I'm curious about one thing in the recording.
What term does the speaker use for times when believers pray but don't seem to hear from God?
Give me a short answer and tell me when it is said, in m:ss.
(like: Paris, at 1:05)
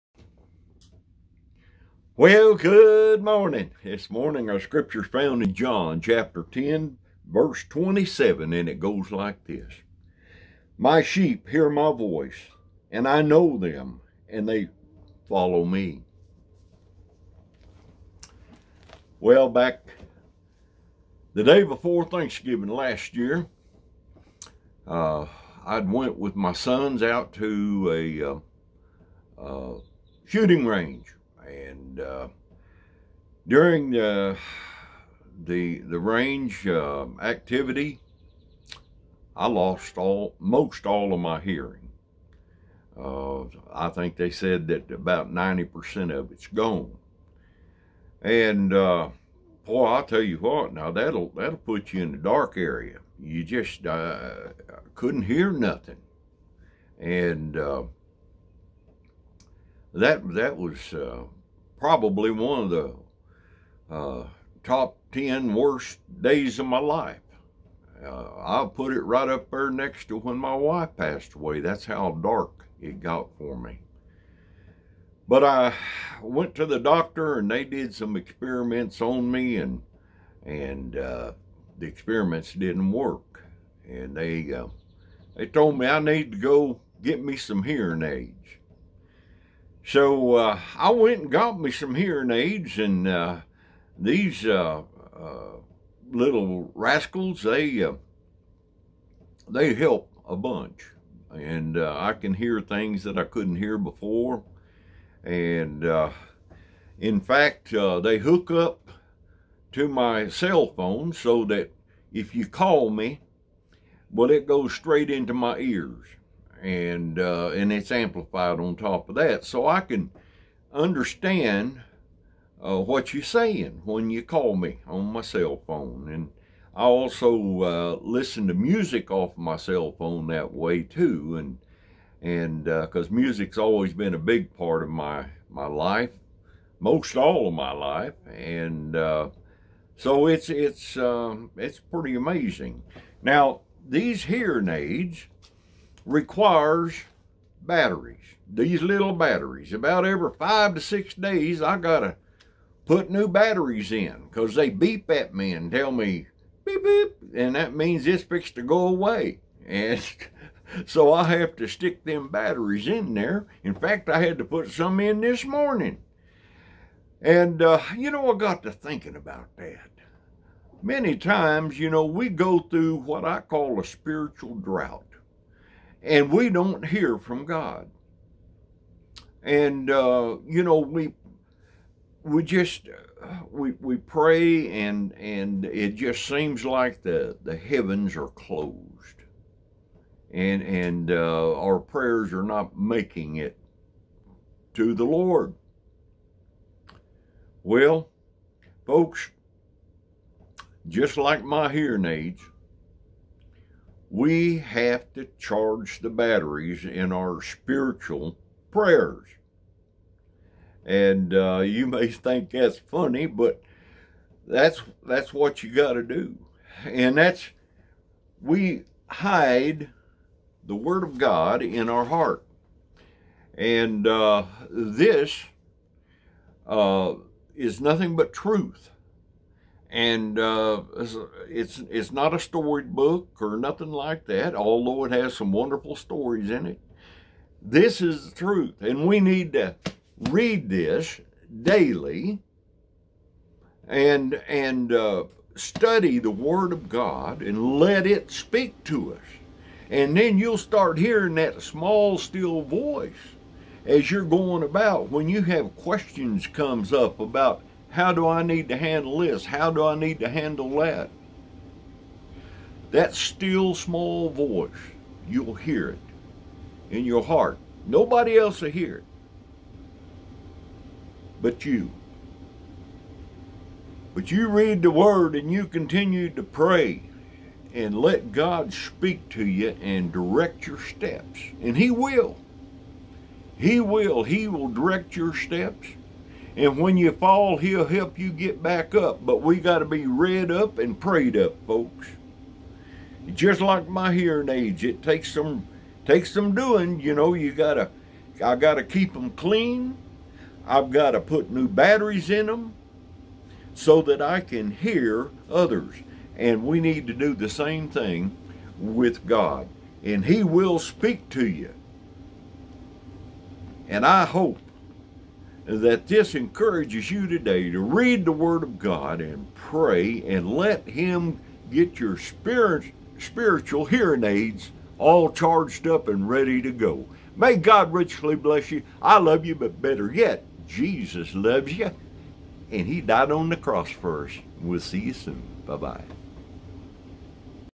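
Spiritual drought, at 2:53.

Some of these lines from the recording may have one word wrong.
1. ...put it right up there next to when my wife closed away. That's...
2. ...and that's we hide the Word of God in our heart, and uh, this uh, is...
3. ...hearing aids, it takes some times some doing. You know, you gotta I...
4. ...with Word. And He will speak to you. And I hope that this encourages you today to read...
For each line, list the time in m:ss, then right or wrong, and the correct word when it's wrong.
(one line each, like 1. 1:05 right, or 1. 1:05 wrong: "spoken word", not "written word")
1. 1:08 wrong: "passed", not "closed"
2. 3:36 right
3. 4:54 wrong: "takes", not "times"
4. 5:08 wrong: "God", not "Word".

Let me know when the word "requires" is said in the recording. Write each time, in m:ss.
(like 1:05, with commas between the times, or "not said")
2:26.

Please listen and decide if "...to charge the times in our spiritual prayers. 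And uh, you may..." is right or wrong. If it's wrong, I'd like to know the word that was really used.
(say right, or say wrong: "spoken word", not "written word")
wrong: "batteries", not "times".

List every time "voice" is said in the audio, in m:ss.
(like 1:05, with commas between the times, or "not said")
0:11, 4:12, 4:24.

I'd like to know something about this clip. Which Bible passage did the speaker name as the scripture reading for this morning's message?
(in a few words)
John 10:27.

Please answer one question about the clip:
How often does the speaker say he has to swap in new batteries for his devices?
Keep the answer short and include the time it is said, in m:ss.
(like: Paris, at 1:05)
Every 5 to 6 days, at 2:30.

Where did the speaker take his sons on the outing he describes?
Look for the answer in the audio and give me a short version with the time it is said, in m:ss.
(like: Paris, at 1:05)
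Shooting range, at 0:30.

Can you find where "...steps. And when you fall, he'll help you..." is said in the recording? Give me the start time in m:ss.
4:45.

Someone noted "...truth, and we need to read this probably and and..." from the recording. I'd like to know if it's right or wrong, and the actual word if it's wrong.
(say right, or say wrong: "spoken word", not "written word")
wrong: "daily", not "probably".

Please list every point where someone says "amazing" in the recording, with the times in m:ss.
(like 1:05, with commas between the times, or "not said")
2:22.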